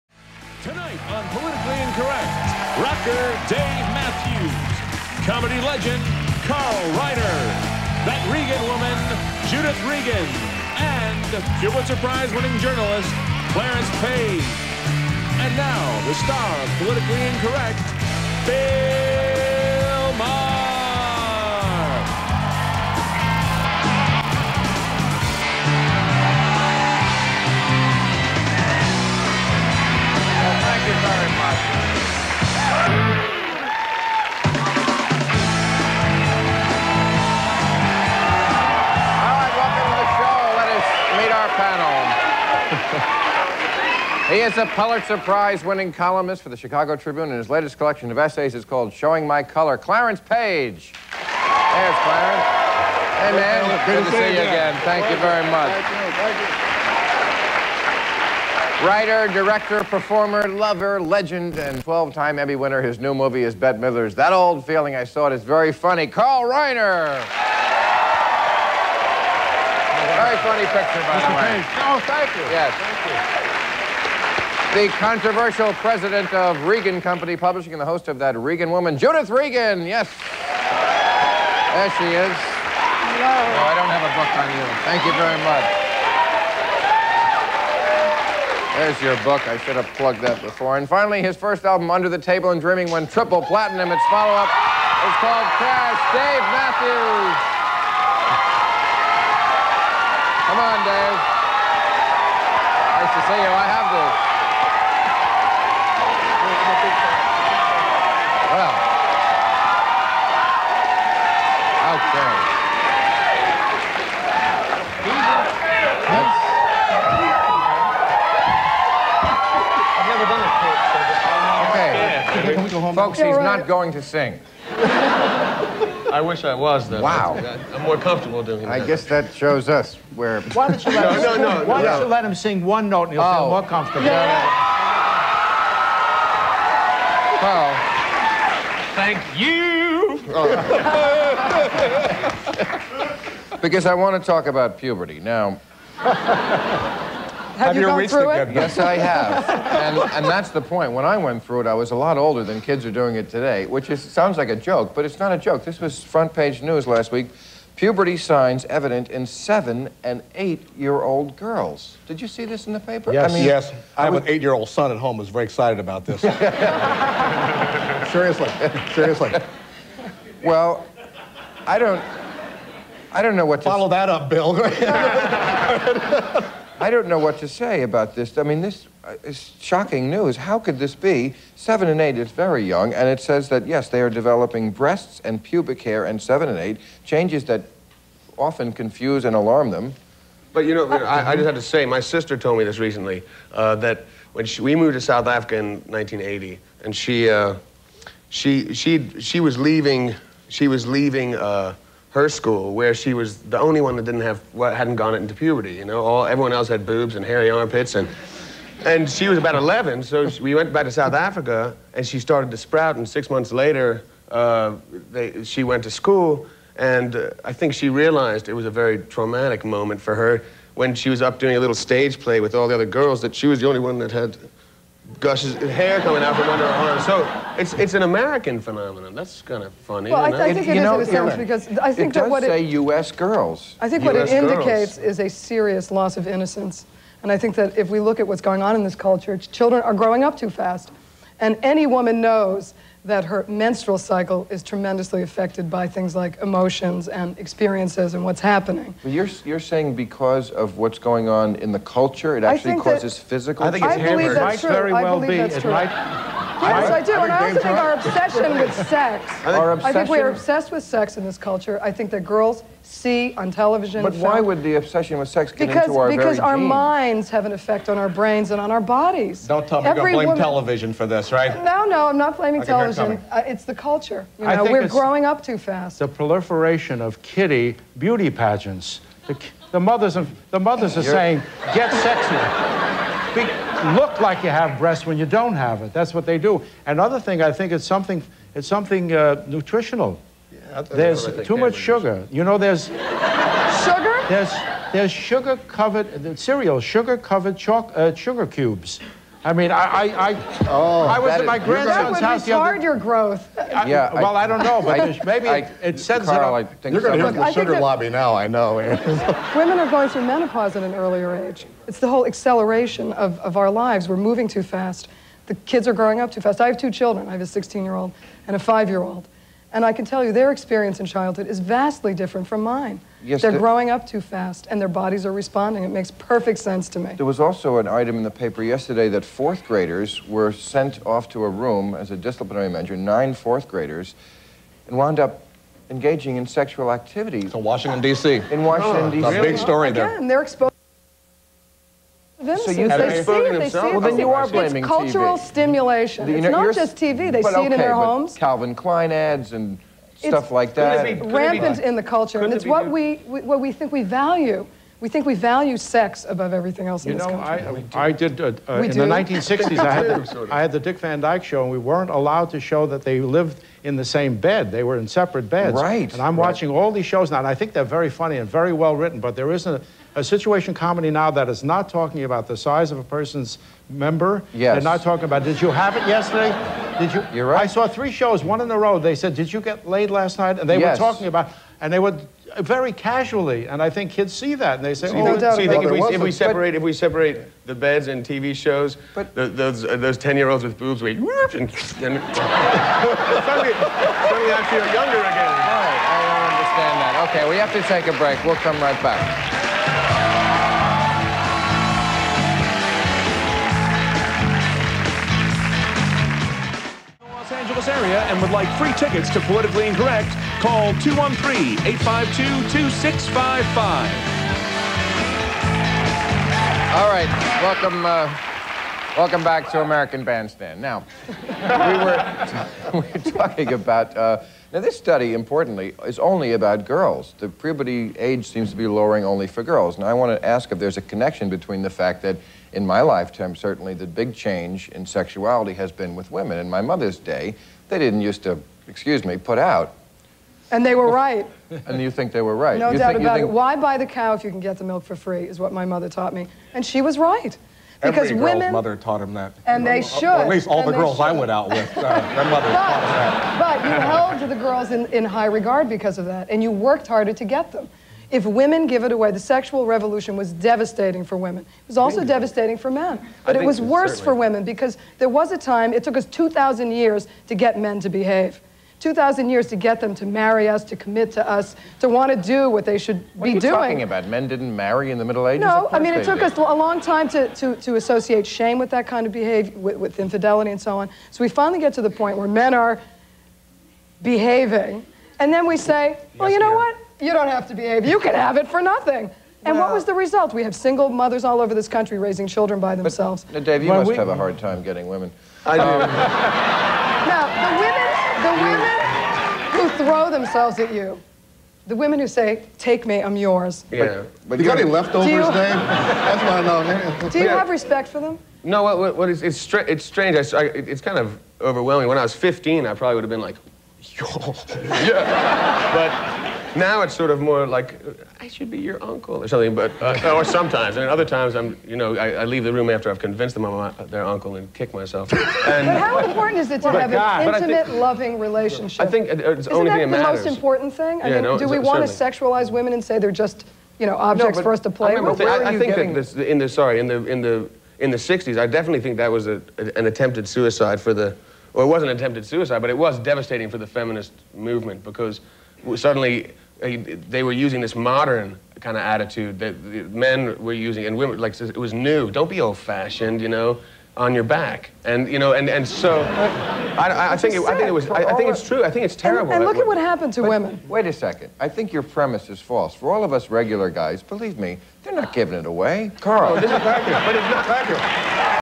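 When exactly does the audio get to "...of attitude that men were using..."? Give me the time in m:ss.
9:08.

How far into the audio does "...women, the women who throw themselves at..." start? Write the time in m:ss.
8:19.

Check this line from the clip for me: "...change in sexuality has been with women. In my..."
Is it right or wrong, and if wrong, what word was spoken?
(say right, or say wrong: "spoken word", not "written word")
right.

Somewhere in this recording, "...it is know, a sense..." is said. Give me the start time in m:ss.
3:50.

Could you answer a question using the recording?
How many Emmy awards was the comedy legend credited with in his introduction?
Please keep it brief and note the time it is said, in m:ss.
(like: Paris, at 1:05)
12, at 1:01.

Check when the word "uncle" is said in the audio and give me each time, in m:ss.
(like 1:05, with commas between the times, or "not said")
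8:39, 8:44.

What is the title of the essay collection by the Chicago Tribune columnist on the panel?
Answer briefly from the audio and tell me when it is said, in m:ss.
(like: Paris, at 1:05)
Showing My Color, at 0:48.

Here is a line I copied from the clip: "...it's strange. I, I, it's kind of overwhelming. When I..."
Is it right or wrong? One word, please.
right.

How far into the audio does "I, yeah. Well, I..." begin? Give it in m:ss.
5:03.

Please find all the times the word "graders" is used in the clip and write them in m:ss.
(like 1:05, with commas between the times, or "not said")
5:29, 5:33.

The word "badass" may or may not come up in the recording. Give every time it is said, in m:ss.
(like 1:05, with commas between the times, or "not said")
not said.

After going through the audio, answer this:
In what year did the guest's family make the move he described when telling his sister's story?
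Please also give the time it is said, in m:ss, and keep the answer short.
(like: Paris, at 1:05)
1980, at 3:15.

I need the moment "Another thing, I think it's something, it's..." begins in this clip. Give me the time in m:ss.
4:46.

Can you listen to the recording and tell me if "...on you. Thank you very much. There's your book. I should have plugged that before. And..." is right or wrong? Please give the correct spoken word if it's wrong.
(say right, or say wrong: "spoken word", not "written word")
right.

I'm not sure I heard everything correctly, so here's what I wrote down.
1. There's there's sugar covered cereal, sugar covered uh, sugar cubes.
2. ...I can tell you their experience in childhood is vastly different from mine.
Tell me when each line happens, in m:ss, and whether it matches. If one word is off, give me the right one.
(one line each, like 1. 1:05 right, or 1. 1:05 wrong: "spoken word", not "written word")
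1. 4:54 right
2. 5:19 right.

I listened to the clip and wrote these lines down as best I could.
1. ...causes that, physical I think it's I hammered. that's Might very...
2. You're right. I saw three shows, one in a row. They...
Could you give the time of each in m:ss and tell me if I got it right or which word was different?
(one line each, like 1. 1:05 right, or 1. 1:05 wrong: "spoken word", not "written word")
1. 4:12 right
2. 6:17 right.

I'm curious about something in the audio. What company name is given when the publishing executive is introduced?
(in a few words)
Regan Company Publishing.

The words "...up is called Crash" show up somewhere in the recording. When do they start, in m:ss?
1:34.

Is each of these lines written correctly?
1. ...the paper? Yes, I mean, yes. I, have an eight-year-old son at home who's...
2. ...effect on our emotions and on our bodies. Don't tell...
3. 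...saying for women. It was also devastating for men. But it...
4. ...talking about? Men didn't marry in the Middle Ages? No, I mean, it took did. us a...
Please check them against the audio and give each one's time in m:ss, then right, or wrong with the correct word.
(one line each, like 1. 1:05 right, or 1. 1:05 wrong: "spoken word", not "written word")
1. 2:42 right
2. 4:27 wrong: "brains", not "emotions"
3. 7:40 wrong: "devastating", not "saying"
4. 7:53 right.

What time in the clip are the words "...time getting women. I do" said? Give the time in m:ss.
8:14.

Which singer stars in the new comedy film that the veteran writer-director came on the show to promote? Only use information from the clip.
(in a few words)
Bette Midler.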